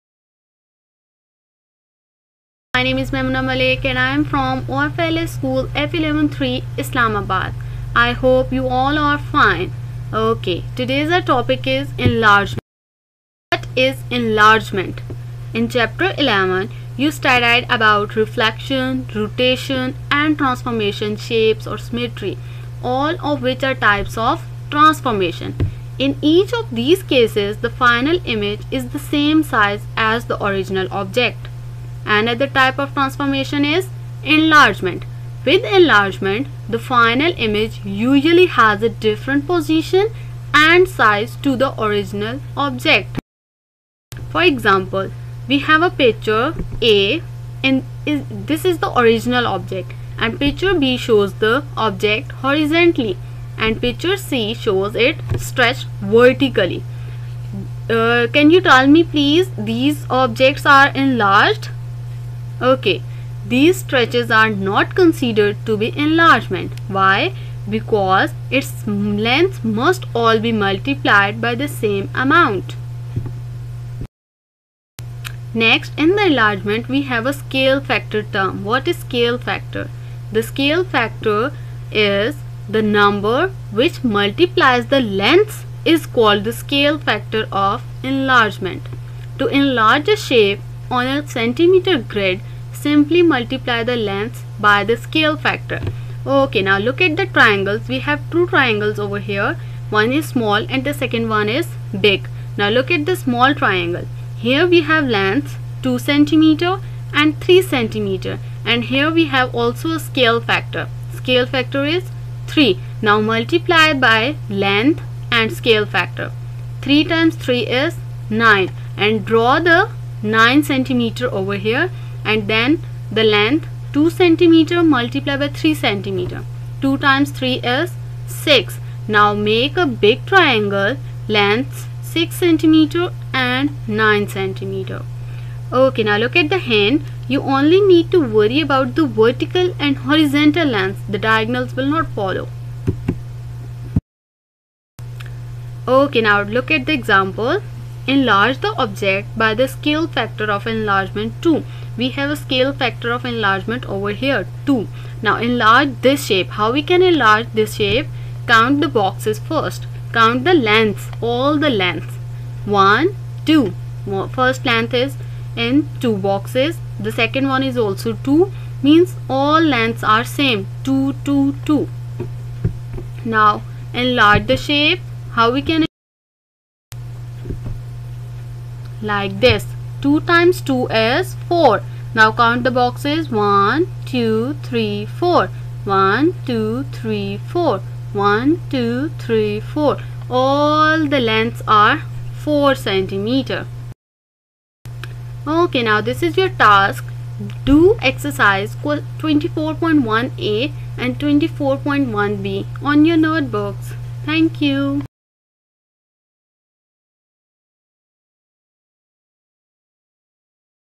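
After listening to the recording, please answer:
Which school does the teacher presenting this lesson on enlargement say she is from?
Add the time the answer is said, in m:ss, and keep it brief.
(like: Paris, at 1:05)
OFLS School F113 Islamabad, at 0:04.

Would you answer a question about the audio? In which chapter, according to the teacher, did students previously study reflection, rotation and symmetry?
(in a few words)
Chapter 11.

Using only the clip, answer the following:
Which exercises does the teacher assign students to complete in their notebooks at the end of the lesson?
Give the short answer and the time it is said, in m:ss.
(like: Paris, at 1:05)
24.1a and 24.1b, at 3:18.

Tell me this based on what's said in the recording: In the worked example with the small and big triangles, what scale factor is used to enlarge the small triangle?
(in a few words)
3.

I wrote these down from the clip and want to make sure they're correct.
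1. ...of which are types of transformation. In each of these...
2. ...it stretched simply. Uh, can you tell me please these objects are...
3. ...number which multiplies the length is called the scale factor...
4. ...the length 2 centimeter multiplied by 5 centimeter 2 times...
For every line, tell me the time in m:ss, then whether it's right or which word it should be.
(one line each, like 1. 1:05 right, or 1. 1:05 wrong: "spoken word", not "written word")
1. 0:23 right
2. 0:54 wrong: "vertically", not "simply"
3. 1:22 right
4. 2:03 wrong: "3", not "5".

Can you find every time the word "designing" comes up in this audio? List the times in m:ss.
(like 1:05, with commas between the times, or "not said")
not said.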